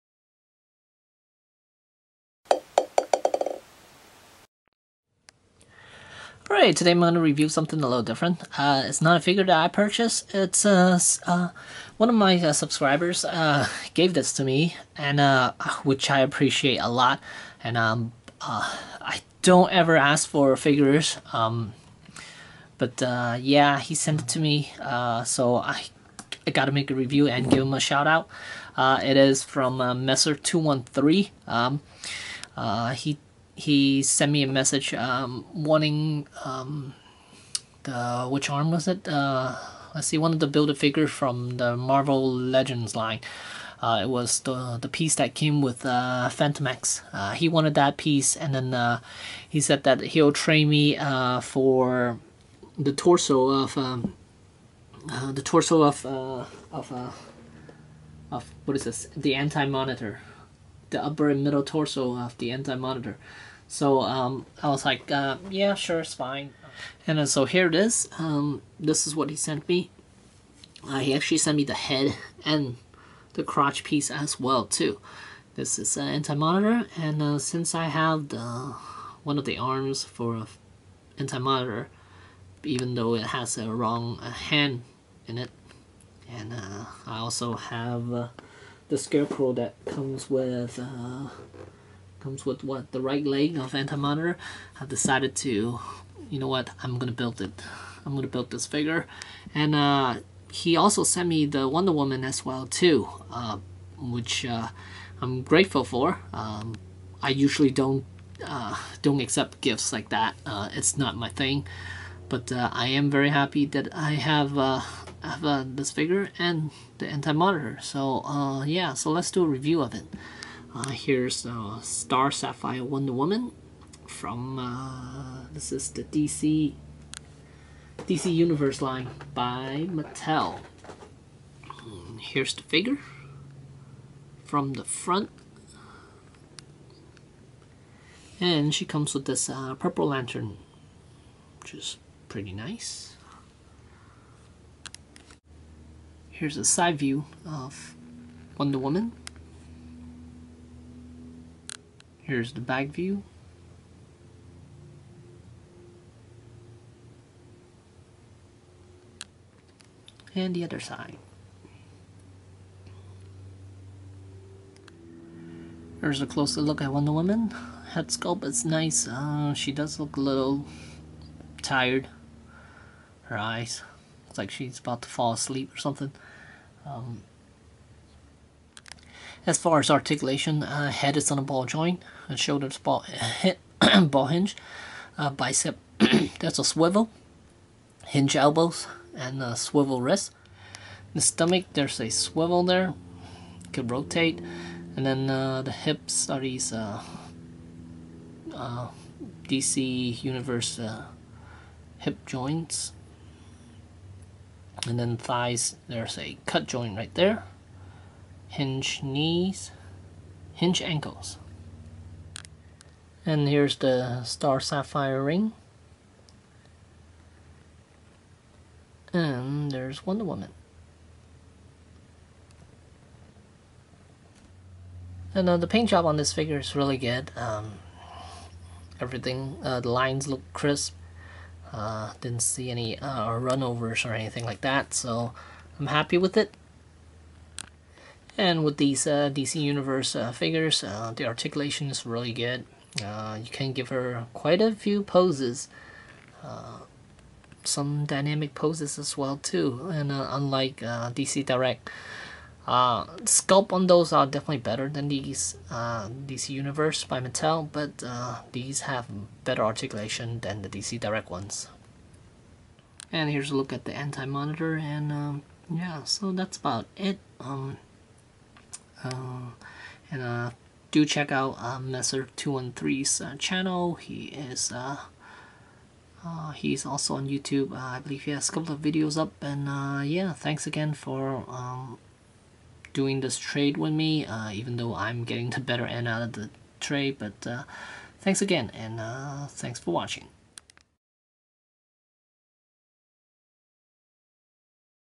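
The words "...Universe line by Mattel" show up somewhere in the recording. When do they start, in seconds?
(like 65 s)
128 s.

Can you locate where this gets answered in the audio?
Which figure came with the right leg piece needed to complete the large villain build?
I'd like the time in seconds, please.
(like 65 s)
88 s.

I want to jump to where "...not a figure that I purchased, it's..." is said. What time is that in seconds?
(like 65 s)
9 s.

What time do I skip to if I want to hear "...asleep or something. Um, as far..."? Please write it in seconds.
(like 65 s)
175 s.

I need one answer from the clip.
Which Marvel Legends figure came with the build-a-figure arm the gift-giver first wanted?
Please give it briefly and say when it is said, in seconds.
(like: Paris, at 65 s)
Phantom X, at 46 s.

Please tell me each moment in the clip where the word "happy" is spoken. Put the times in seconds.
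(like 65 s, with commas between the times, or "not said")
113 s, 235 s.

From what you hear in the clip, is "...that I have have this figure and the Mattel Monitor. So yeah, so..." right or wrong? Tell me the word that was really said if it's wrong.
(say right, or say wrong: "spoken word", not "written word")
wrong: "Anti", not "Mattel".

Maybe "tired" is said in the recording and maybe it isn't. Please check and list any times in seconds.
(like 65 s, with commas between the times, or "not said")
171 s.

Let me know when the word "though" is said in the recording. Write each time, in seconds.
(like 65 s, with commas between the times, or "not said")
82 s, 284 s.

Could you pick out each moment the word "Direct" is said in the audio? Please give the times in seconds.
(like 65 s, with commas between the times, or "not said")
251 s, 260 s.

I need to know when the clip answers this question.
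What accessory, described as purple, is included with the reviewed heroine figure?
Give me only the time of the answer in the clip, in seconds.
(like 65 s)
139 s.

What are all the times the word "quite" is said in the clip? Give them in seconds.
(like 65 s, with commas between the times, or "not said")
244 s.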